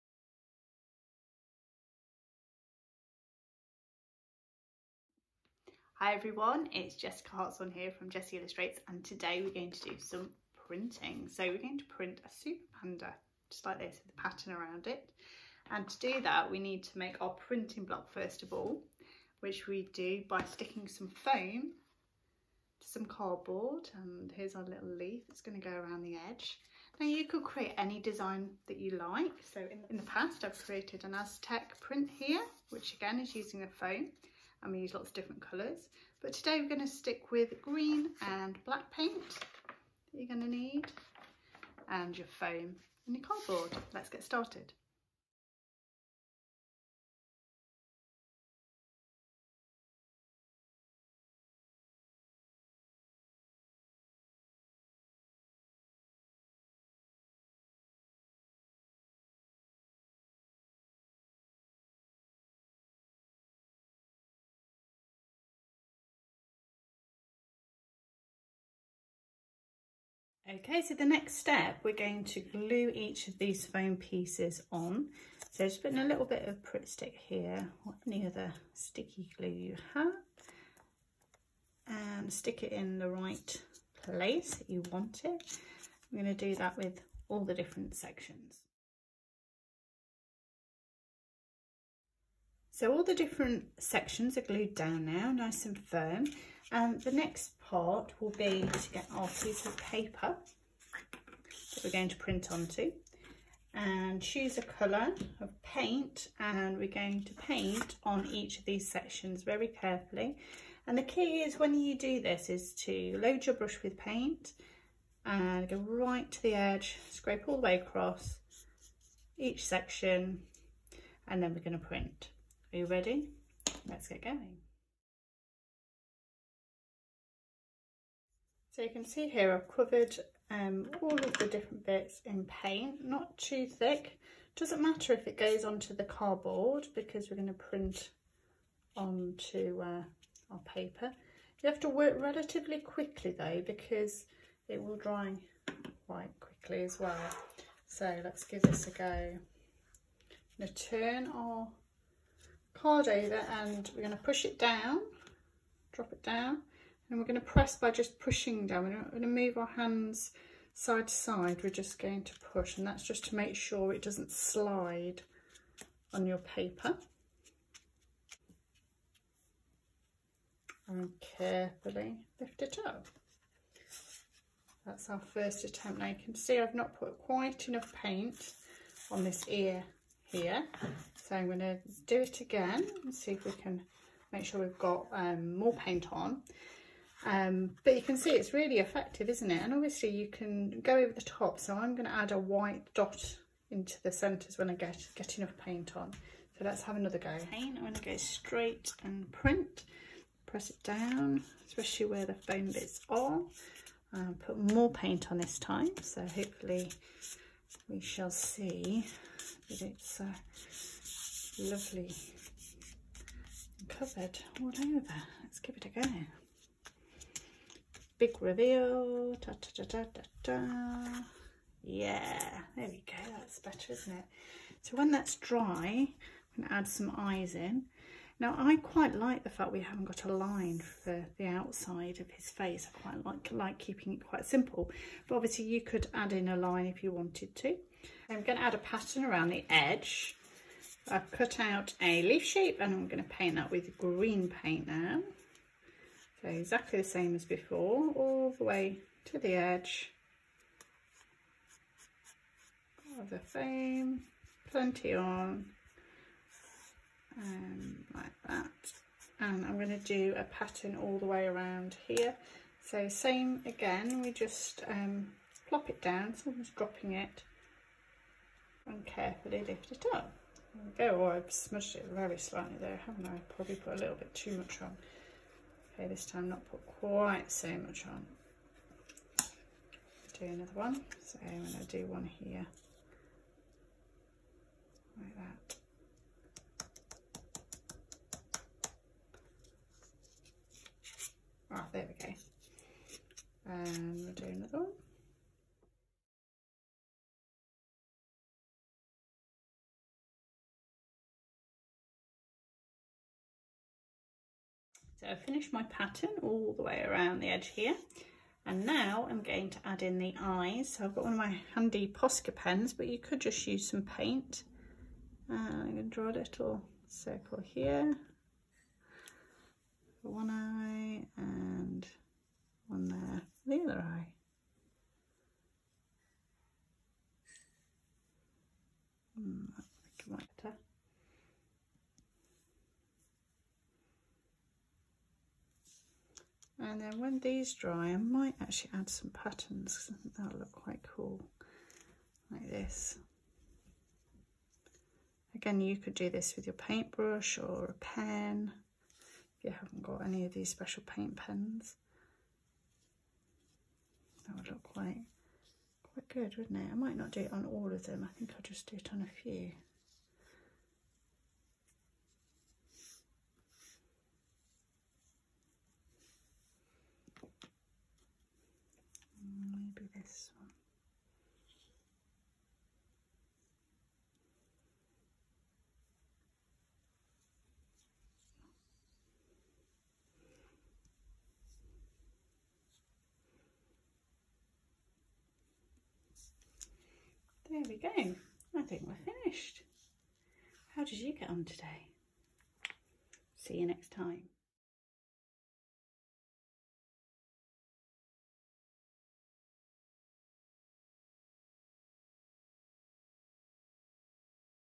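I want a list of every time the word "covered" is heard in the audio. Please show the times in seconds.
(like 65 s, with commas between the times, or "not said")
129 s, 213 s.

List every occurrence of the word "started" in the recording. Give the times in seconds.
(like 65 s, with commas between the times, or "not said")
44 s.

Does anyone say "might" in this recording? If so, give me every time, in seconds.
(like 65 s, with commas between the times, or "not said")
338 s, 356 s.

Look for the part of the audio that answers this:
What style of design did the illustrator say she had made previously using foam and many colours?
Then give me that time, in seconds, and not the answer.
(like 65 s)
31 s.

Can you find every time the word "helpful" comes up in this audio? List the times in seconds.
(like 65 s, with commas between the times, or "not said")
not said.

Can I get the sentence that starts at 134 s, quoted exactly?
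Doesn't matter if it goes onto the cardboard because we're going to print onto uh, our paper.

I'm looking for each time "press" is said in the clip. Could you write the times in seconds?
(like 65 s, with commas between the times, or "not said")
157 s, 200 s.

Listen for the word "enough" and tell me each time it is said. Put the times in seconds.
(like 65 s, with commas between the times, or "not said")
177 s, 195 s.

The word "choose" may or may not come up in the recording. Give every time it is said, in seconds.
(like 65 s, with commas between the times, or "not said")
104 s.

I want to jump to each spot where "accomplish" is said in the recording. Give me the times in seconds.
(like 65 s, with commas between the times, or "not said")
not said.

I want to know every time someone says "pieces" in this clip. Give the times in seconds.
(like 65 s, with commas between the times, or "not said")
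73 s, 99 s.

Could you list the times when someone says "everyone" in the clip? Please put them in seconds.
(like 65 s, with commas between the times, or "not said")
6 s.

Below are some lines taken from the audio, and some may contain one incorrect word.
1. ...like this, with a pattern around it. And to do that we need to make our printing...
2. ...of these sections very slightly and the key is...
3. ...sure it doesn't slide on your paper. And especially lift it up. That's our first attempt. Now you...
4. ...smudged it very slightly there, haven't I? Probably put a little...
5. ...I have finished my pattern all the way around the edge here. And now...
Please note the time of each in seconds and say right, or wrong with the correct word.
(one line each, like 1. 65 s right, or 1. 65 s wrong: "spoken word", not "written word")
1. 13 s right
2. 108 s wrong: "carefully", not "slightly"
3. 163 s wrong: "carefully", not "especially"
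4. 271 s right
5. 305 s right.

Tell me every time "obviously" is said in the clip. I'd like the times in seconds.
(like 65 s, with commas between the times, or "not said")
189 s, 235 s.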